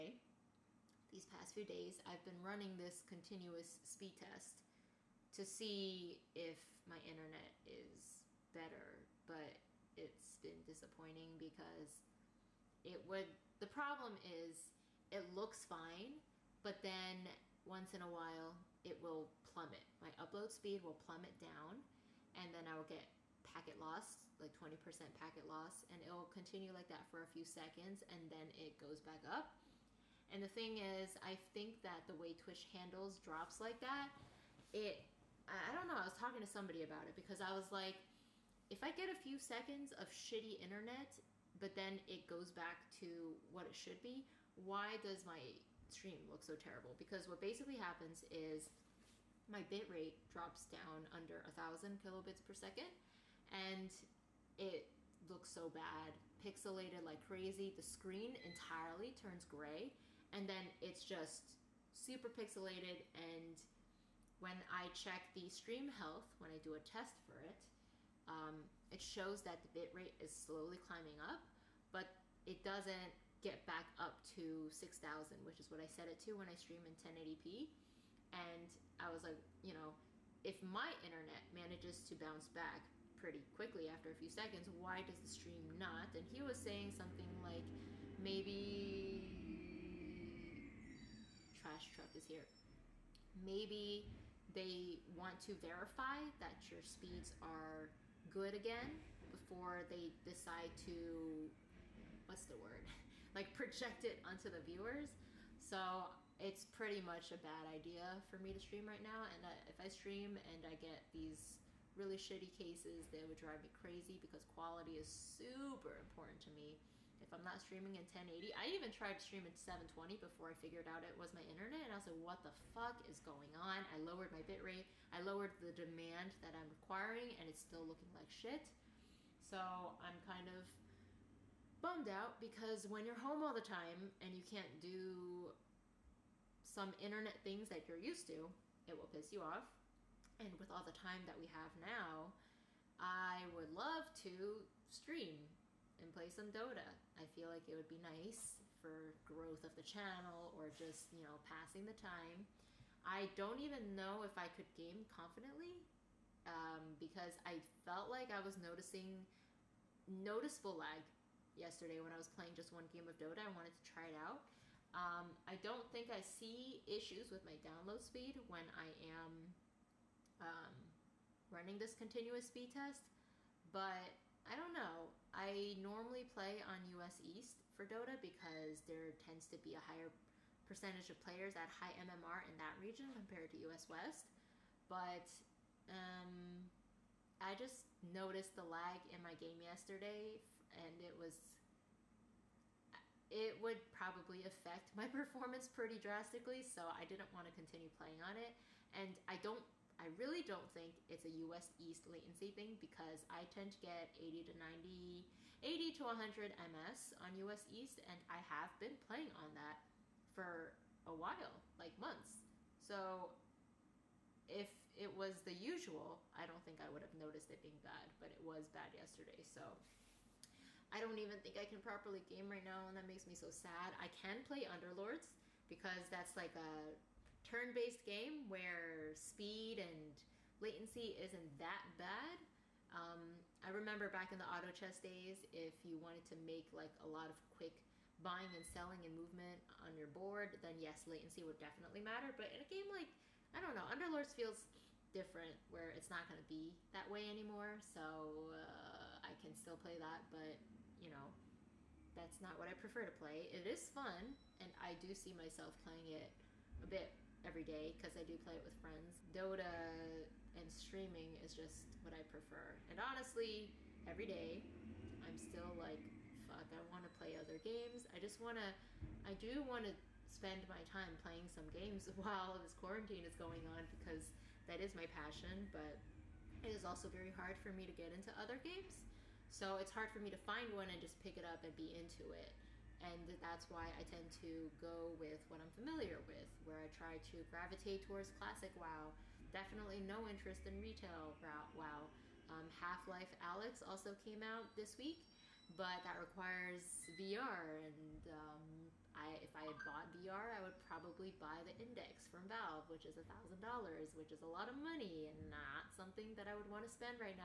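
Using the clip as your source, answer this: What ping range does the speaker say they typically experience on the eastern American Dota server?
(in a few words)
80 to 100 ms.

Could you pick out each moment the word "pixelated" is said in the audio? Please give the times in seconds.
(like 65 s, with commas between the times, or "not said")
56 s, 62 s.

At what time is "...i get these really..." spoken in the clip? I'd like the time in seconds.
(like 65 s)
110 s.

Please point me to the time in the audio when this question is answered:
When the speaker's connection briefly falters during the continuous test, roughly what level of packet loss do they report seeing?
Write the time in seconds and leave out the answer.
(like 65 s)
24 s.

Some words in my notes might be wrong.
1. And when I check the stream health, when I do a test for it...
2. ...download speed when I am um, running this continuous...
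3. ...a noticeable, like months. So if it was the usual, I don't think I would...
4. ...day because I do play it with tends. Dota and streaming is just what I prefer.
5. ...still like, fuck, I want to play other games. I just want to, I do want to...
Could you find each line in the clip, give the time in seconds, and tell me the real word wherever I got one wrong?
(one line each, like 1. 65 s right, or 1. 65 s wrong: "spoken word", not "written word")
1. 63 s right
2. 167 s right
3. 211 s wrong: "while", not "noticeable"
4. 257 s wrong: "friends", not "tends"
5. 265 s right.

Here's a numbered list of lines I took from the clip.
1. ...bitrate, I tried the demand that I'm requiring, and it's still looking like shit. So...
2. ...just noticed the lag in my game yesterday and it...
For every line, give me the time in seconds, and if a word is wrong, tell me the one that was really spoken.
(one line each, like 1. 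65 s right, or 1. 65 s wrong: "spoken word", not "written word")
1. 124 s wrong: "lowered", not "tried"
2. 187 s right.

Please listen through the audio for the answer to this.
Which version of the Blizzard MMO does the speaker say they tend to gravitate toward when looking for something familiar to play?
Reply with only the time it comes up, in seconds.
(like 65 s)
288 s.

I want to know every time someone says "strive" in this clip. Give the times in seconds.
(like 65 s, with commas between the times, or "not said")
not said.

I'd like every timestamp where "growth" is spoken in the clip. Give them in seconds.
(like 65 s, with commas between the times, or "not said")
149 s.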